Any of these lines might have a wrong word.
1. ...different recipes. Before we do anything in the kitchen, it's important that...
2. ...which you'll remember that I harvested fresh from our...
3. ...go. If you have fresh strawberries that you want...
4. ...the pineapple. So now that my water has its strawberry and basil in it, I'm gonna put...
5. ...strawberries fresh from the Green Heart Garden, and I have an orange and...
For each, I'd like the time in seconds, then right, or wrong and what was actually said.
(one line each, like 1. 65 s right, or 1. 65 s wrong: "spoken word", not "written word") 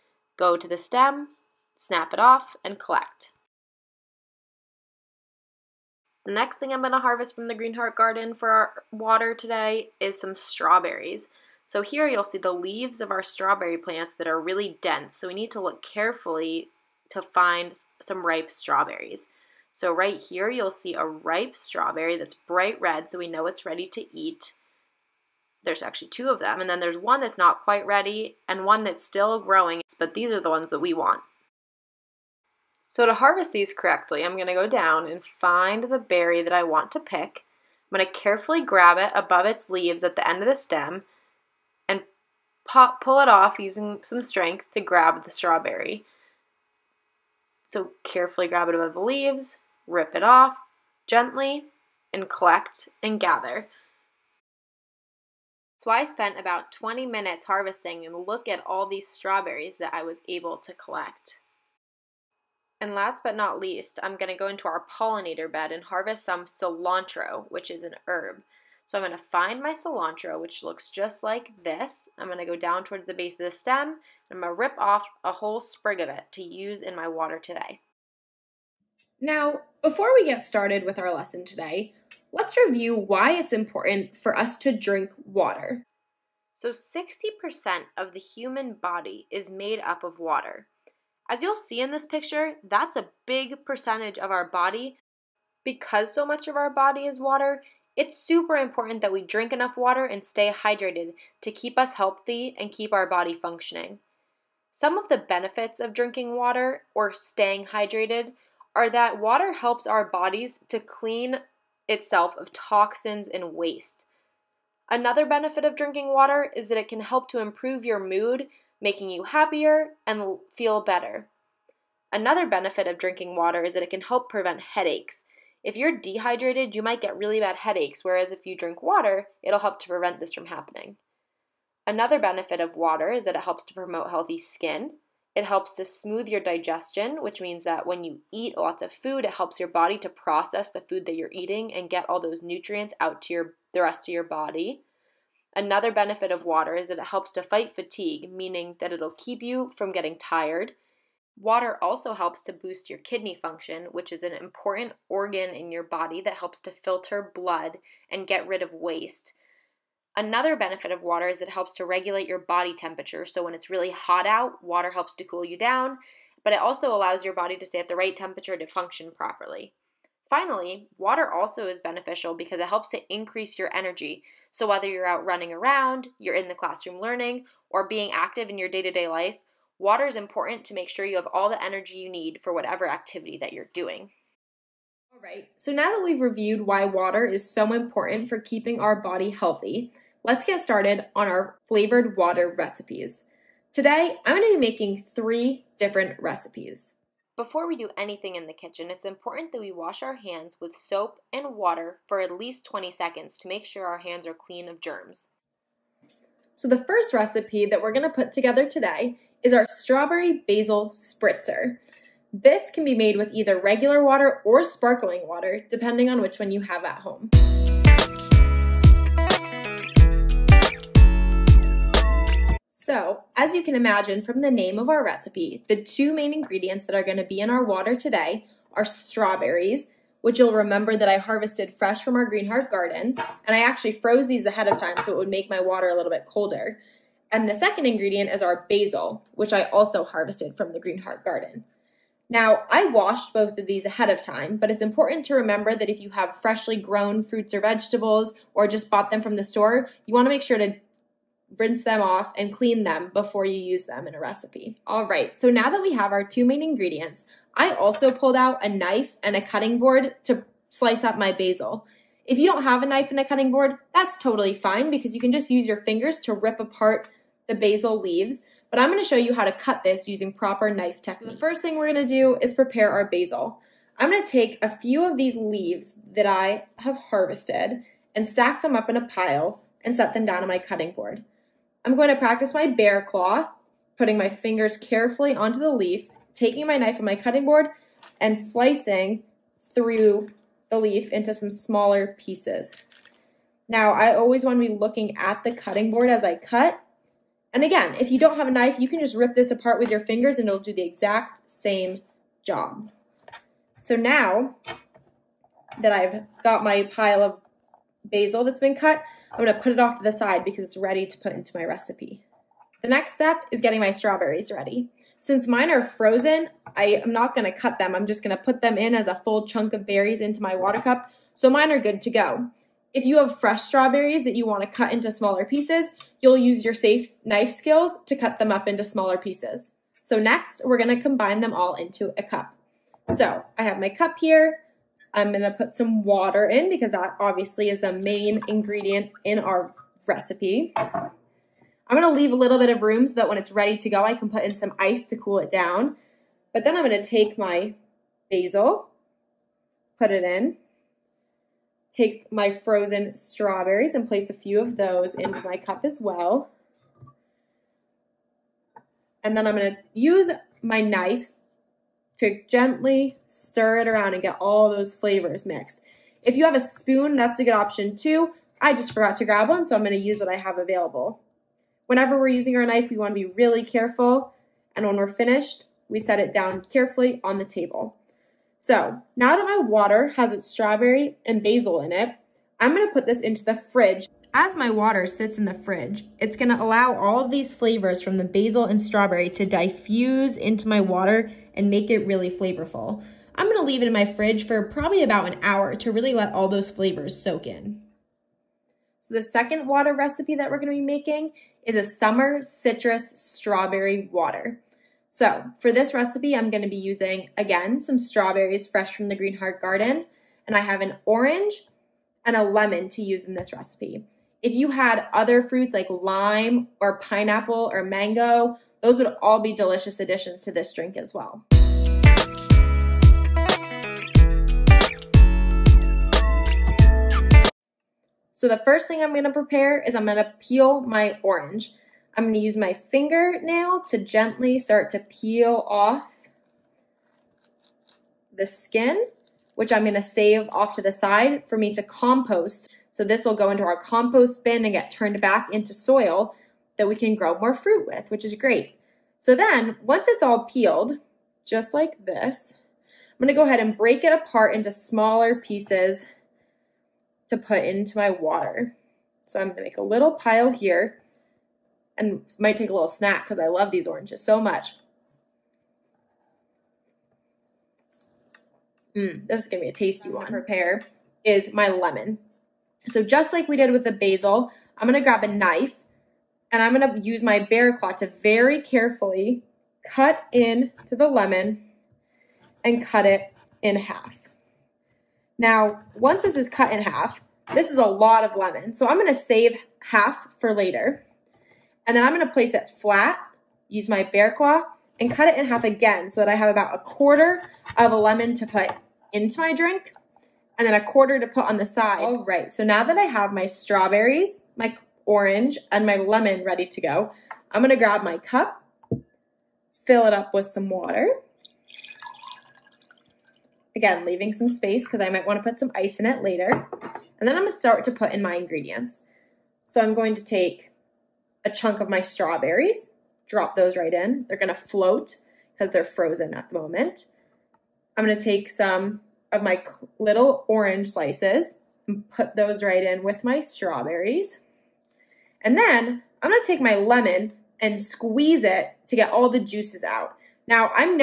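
1. 195 s right
2. 230 s right
3. 322 s right
4. 377 s wrong: "table", not "pineapple"
5. 407 s right.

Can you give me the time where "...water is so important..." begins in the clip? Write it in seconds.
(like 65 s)
186 s.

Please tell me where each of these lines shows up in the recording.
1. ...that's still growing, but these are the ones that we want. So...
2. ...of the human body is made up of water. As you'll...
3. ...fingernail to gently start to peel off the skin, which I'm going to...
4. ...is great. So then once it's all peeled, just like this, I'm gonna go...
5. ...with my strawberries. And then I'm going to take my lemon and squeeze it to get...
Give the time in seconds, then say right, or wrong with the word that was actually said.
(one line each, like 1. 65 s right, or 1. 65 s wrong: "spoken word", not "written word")
1. 28 s right
2. 87 s right
3. 432 s right
4. 448 s right
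5. 533 s right.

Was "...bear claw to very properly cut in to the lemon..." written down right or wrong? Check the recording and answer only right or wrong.
wrong.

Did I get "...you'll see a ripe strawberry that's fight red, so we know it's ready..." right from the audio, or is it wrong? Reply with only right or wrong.
wrong.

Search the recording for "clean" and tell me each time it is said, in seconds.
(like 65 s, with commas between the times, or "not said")
110 s, 204 s, 252 s.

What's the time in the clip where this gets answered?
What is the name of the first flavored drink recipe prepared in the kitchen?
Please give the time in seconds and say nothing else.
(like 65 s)
209 s.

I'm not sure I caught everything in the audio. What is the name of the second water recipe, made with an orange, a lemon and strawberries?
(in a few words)
Summer citrus strawberry water.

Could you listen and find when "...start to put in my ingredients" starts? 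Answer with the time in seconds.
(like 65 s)
517 s.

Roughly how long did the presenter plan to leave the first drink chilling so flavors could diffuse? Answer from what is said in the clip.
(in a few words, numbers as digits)
About an hour.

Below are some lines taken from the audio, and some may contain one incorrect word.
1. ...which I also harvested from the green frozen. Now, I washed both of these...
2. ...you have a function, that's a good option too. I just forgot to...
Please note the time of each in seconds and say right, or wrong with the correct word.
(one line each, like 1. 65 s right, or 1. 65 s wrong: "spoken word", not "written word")
1. 239 s wrong: "garden", not "frozen"
2. 366 s wrong: "spoon", not "function".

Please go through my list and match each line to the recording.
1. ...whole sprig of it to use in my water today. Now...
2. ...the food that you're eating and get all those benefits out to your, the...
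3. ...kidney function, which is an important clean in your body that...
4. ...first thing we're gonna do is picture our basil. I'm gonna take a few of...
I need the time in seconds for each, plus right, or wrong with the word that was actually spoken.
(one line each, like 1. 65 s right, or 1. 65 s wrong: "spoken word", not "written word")
1. 75 s right
2. 140 s wrong: "nutrients", not "benefits"
3. 152 s wrong: "organ", not "clean"
4. 271 s wrong: "prepare", not "picture".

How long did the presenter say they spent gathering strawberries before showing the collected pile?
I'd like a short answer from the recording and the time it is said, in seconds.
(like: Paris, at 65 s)
20 minutes, at 56 s.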